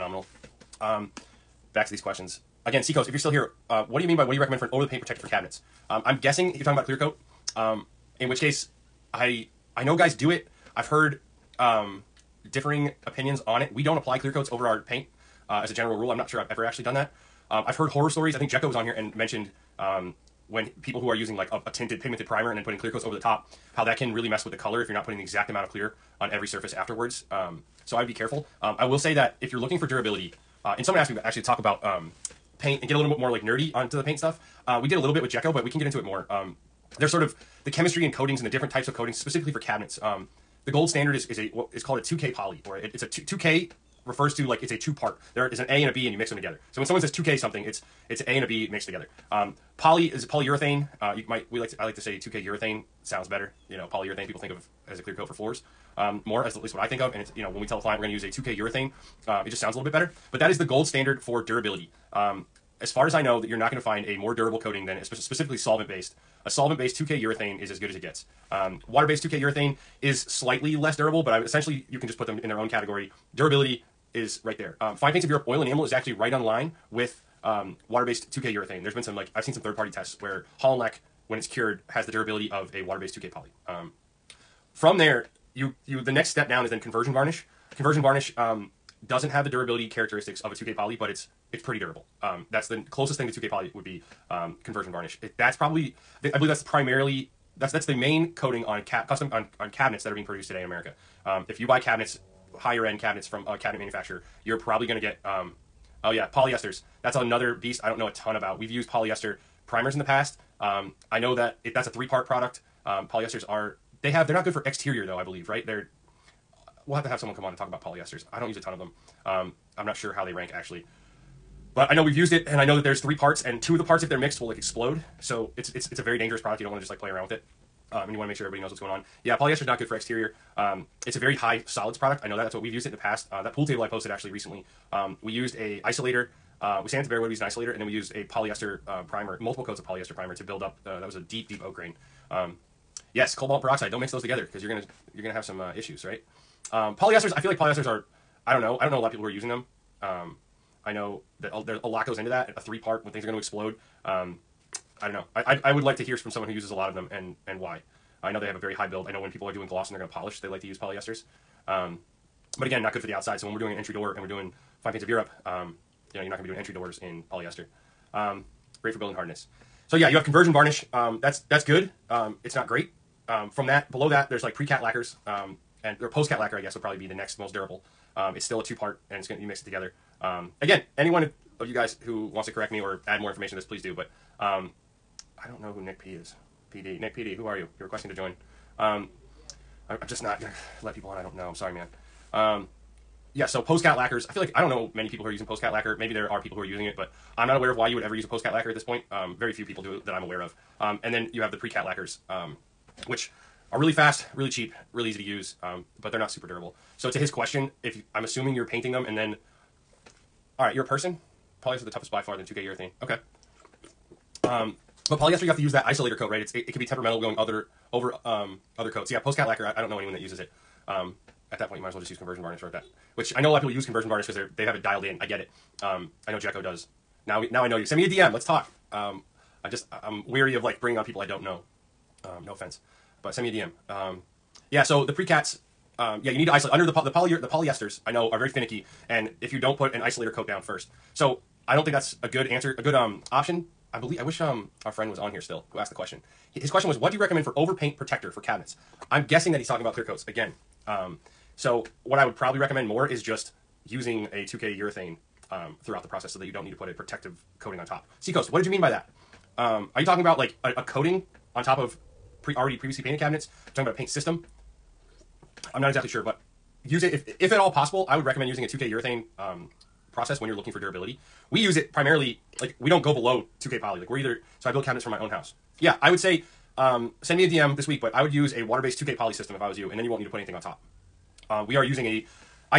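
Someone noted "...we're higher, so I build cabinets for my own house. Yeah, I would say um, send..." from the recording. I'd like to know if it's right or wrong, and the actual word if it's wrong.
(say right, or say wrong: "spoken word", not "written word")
wrong: "either", not "higher".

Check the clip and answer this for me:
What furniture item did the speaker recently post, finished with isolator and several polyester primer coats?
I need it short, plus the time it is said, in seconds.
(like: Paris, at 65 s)
Pool table, at 133 s.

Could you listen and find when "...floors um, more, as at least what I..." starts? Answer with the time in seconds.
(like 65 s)
55 s.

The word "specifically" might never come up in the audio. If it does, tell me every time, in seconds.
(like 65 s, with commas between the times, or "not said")
39 s, 65 s.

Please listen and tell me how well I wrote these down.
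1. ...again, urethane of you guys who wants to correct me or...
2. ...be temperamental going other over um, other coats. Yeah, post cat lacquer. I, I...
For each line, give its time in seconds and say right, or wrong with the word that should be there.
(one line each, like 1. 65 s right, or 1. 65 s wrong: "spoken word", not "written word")
1. 180 s wrong: "anyone", not "urethane"
2. 216 s right.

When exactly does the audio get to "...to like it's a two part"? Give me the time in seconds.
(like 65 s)
44 s.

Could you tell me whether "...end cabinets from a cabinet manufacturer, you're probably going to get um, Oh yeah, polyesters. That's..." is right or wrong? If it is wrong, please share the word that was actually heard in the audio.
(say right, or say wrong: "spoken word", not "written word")
right.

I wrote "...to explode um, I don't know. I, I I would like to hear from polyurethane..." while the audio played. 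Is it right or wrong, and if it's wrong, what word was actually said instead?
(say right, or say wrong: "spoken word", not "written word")
wrong: "someone", not "polyurethane".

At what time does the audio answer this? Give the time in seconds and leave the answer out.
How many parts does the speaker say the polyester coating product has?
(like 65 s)
111 s.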